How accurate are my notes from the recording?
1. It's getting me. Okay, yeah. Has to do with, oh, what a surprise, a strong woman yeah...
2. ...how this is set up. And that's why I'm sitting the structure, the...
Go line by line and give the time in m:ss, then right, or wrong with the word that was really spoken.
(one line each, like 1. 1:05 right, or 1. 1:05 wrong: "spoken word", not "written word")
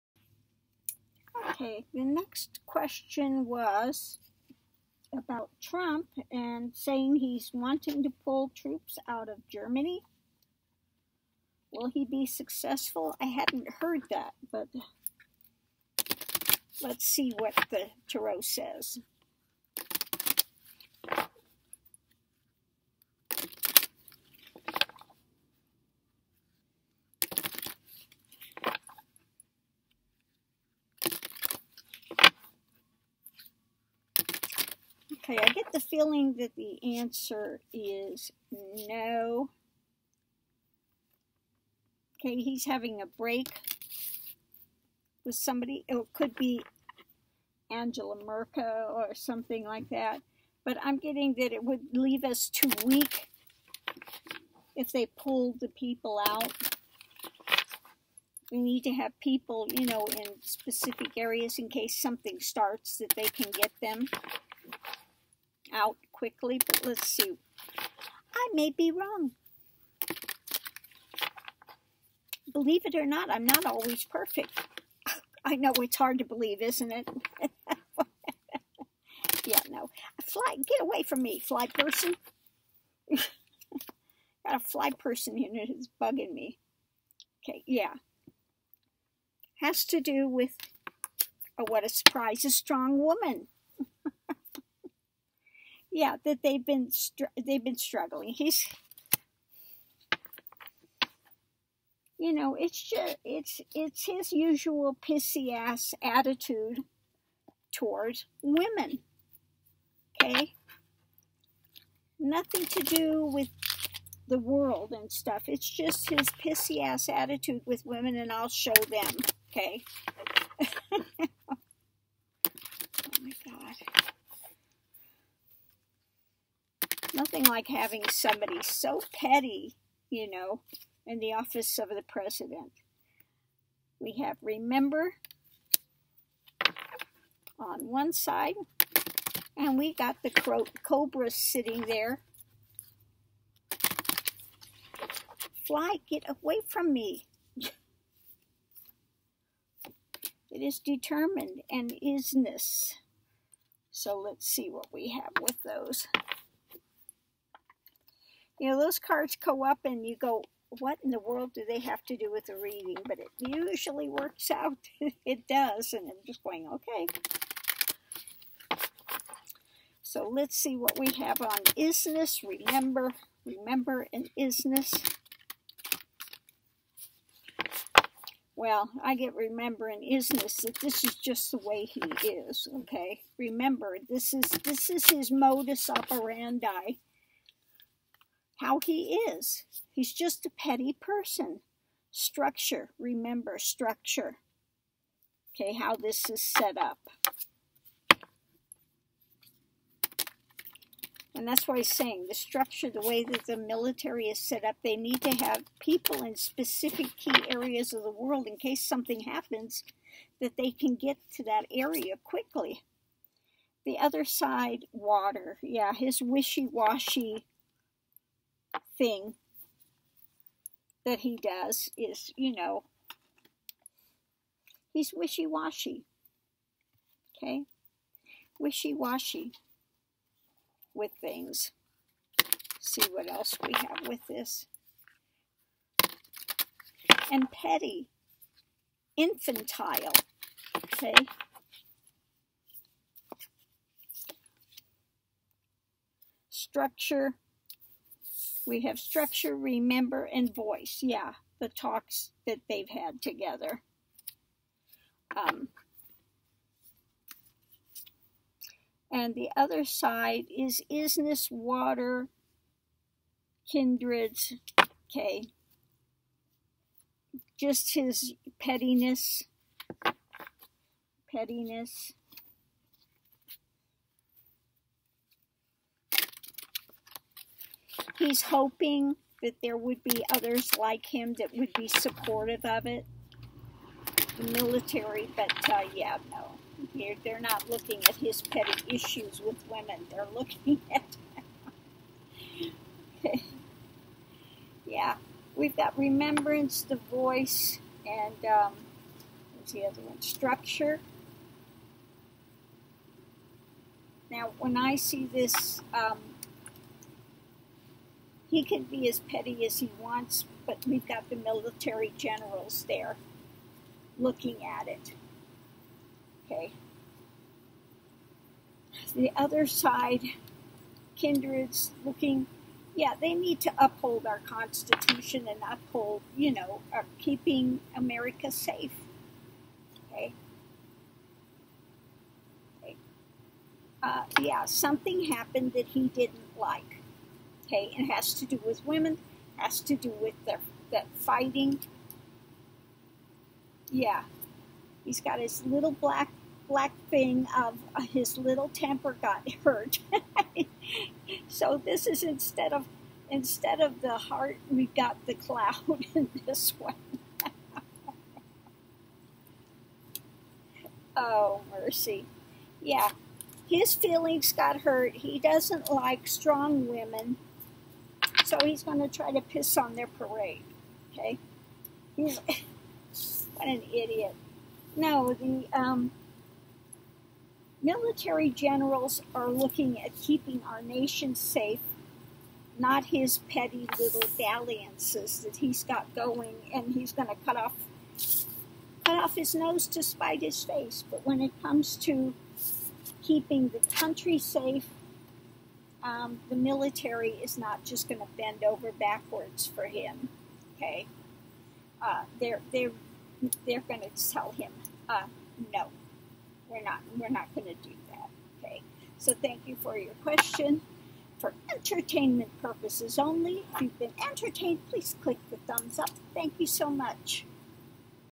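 1. 1:25 wrong: "bugging", not "getting"
2. 3:15 wrong: "saying", not "sitting".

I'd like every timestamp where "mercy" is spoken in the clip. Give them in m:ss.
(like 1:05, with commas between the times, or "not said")
6:01.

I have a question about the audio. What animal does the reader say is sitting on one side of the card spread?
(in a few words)
cobra.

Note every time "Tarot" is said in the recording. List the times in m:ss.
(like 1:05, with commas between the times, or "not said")
0:18.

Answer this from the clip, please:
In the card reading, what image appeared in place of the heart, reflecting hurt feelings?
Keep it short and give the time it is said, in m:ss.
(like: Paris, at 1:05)
the cloud, at 5:55.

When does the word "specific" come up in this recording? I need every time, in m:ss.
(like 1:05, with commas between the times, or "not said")
1:00, 3:26.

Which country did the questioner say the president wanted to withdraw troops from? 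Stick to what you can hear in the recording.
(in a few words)
Germany.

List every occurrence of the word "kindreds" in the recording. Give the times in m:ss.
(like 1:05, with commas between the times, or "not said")
4:23, 5:21.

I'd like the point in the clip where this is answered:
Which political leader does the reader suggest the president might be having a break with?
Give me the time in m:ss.
0:47.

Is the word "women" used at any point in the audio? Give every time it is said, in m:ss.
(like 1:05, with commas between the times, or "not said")
1:48, 1:57, 4:49, 5:38, 6:06.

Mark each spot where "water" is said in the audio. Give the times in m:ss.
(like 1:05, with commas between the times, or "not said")
3:34, 4:21.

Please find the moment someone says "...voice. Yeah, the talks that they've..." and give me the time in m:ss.
4:10.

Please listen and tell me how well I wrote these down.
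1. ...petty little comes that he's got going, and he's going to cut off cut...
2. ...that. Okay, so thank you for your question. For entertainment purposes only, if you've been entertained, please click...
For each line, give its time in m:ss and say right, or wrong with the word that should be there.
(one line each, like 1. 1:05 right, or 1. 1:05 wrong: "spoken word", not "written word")
1. 6:23 wrong: "dalliances", not "comes"
2. 6:48 right.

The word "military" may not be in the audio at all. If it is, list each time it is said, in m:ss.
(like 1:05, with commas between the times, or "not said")
3:23, 4:44, 5:11, 6:17, 6:36.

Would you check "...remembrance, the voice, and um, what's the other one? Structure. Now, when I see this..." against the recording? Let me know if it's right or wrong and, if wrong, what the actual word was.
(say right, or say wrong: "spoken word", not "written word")
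right.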